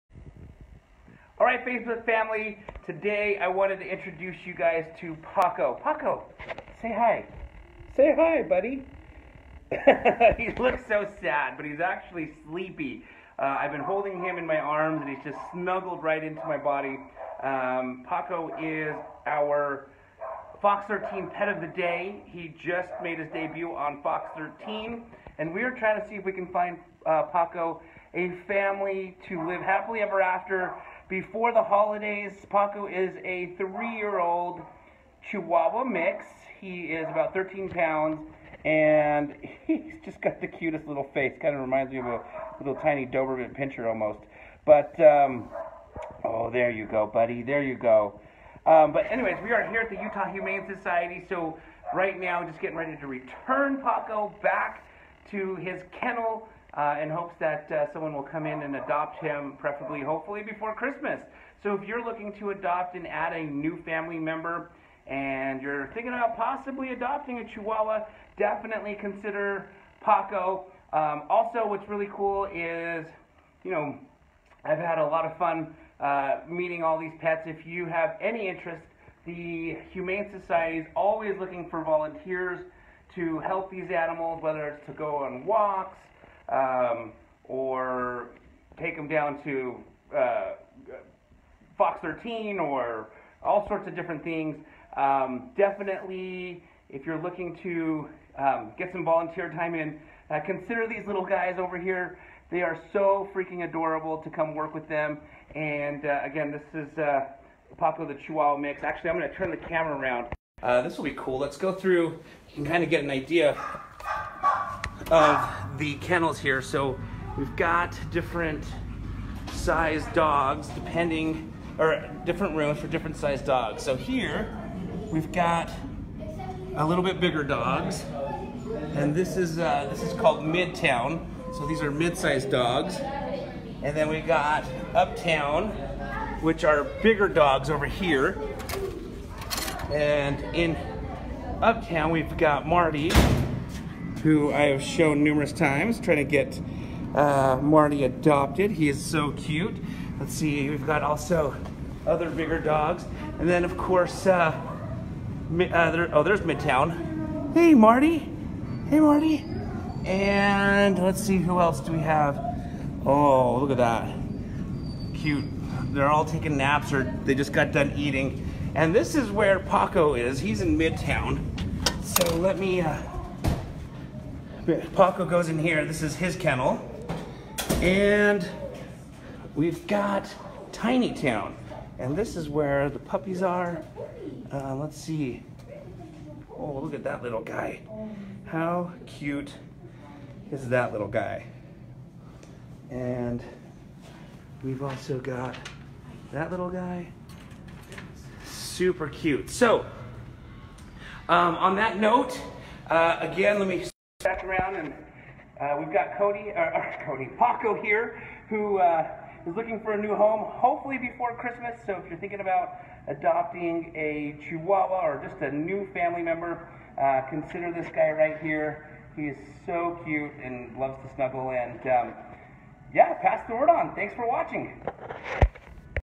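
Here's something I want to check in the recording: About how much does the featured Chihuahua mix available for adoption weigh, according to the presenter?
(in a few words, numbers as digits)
13 pounds.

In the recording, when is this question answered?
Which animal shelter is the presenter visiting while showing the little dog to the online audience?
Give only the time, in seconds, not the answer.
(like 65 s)
50 s.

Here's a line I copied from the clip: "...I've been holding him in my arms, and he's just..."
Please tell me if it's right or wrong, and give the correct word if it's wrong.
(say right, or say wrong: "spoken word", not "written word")
right.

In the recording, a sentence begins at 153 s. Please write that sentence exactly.
And then of course, uh, uh, there, oh, there's Midtown.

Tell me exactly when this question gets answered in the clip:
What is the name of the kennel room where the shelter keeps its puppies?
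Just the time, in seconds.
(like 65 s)
180 s.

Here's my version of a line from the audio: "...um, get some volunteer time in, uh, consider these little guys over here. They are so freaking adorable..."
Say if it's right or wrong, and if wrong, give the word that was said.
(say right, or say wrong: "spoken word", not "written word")
right.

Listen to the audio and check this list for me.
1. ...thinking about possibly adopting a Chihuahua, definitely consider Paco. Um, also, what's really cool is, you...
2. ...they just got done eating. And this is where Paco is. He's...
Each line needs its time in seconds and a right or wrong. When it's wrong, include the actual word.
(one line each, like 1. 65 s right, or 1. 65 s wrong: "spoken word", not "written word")
1. 65 s right
2. 167 s right.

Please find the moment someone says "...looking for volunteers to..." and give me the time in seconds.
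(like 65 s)
81 s.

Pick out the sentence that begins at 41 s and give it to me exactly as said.
Kind of reminds me of a little tiny Doberman Pinscher almost.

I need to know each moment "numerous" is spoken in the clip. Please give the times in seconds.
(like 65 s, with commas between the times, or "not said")
145 s.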